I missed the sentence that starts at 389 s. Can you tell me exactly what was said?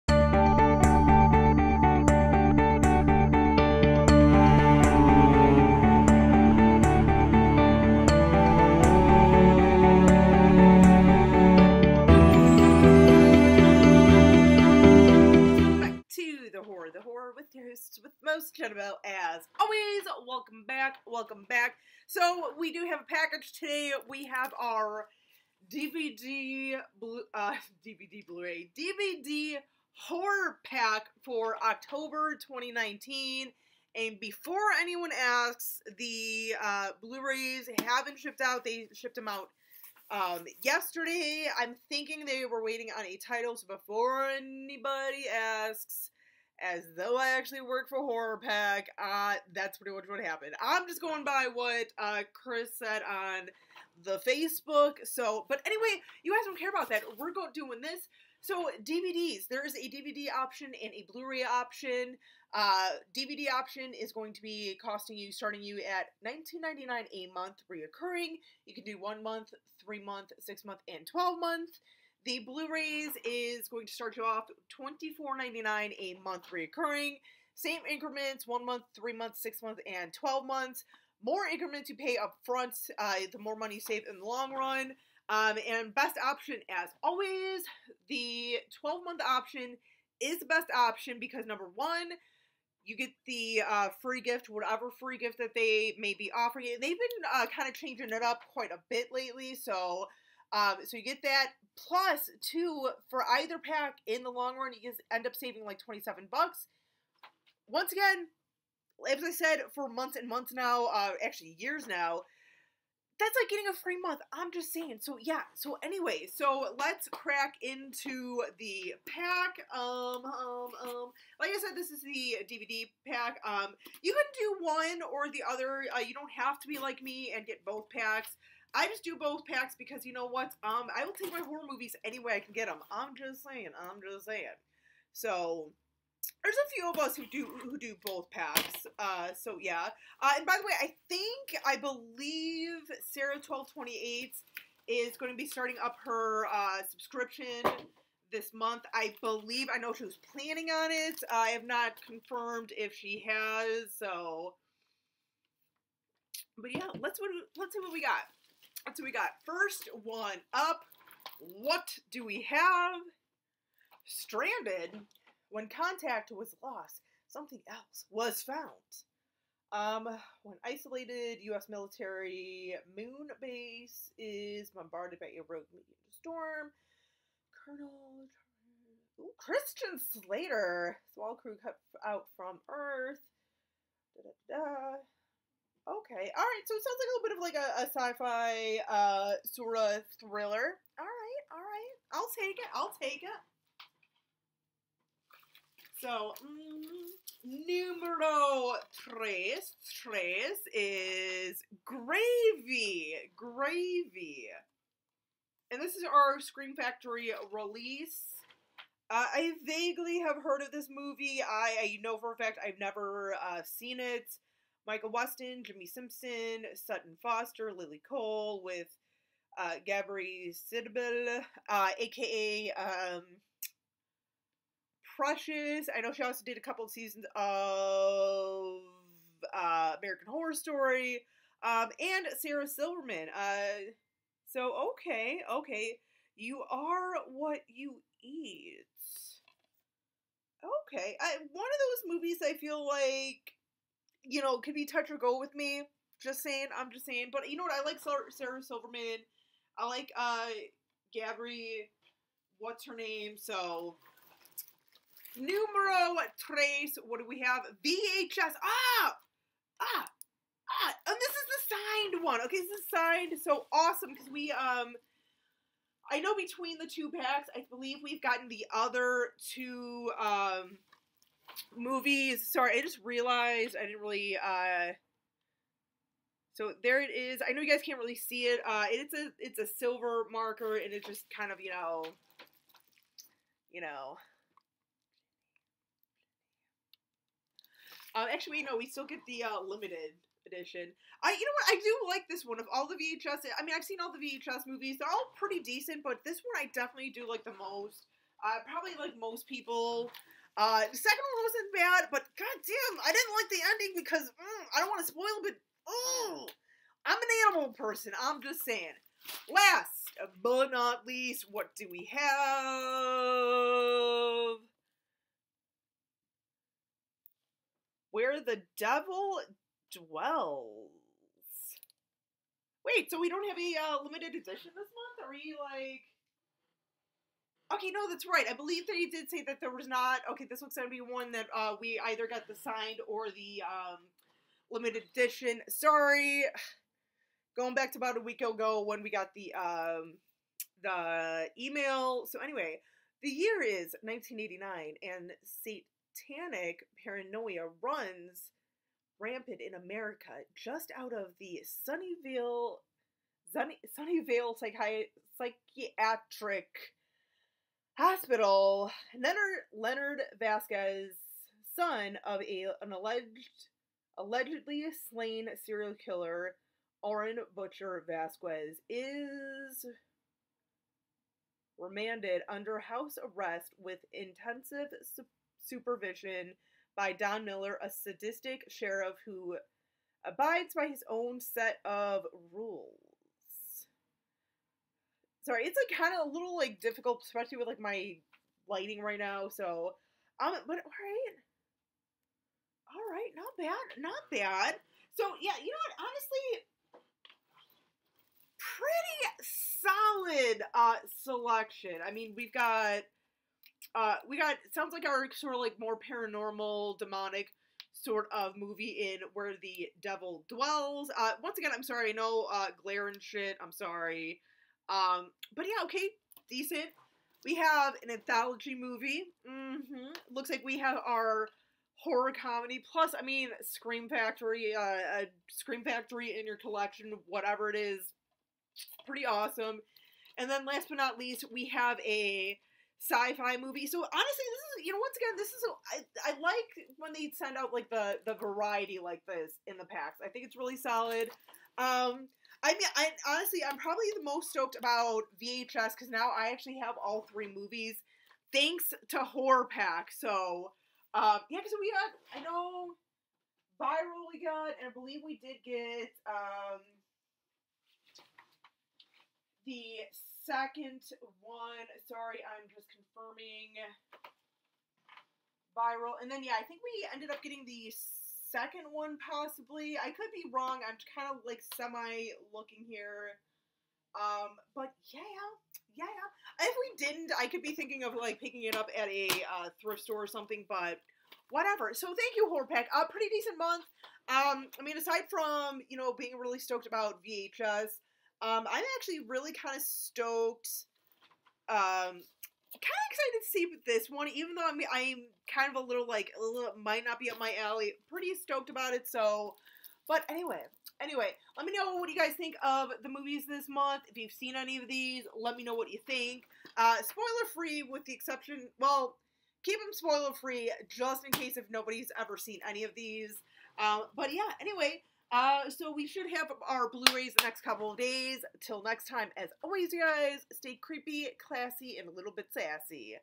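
So, um, but all right, all right, not bad, not bad.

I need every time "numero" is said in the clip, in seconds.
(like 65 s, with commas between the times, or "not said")
197 s, 255 s.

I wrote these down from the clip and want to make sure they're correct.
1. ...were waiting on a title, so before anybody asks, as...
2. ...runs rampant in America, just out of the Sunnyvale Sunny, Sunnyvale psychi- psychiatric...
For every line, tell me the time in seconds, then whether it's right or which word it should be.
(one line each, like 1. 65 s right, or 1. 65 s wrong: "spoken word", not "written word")
1. 42 s right
2. 347 s right.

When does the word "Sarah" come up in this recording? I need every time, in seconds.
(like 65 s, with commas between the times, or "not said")
143 s, 232 s, 248 s.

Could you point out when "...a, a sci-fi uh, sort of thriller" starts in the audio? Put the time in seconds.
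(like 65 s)
187 s.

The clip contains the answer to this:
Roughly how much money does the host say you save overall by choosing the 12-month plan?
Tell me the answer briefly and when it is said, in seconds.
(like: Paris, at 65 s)
27 bucks, at 105 s.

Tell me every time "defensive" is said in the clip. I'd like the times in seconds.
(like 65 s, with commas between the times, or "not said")
not said.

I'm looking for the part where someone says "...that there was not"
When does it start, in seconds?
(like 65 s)
329 s.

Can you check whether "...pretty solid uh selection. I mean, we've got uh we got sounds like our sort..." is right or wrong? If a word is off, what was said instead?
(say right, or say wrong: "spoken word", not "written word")
right.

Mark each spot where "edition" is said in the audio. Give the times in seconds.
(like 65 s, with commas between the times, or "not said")
290 s, 324 s, 335 s.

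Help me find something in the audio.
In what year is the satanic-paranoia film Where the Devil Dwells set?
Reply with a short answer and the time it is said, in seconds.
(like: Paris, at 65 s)
1989, at 344 s.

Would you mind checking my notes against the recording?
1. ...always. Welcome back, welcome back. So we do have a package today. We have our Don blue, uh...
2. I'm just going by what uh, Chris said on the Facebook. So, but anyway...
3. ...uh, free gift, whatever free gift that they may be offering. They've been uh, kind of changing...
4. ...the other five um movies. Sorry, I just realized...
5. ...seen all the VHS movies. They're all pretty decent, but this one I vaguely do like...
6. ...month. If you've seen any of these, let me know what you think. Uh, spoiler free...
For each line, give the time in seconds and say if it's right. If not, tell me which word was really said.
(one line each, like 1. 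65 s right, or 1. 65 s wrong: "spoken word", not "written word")
1. 19 s wrong: "DVD", not "Don"
2. 50 s right
3. 93 s right
4. 268 s wrong: "two", not "five"
5. 293 s wrong: "definitely", not "vaguely"
6. 503 s right.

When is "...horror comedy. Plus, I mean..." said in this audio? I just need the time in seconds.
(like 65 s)
422 s.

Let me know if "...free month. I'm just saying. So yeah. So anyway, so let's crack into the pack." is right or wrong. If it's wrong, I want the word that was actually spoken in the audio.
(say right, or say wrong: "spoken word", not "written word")
right.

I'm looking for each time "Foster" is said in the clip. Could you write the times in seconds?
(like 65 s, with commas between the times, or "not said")
217 s.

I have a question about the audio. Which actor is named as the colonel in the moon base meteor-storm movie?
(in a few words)
Christian Slater.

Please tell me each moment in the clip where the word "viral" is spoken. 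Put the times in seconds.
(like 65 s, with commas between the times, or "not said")
453 s, 465 s.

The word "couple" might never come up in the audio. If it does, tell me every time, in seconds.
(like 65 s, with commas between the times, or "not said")
226 s, 517 s.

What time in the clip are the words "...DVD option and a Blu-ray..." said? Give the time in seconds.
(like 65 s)
59 s.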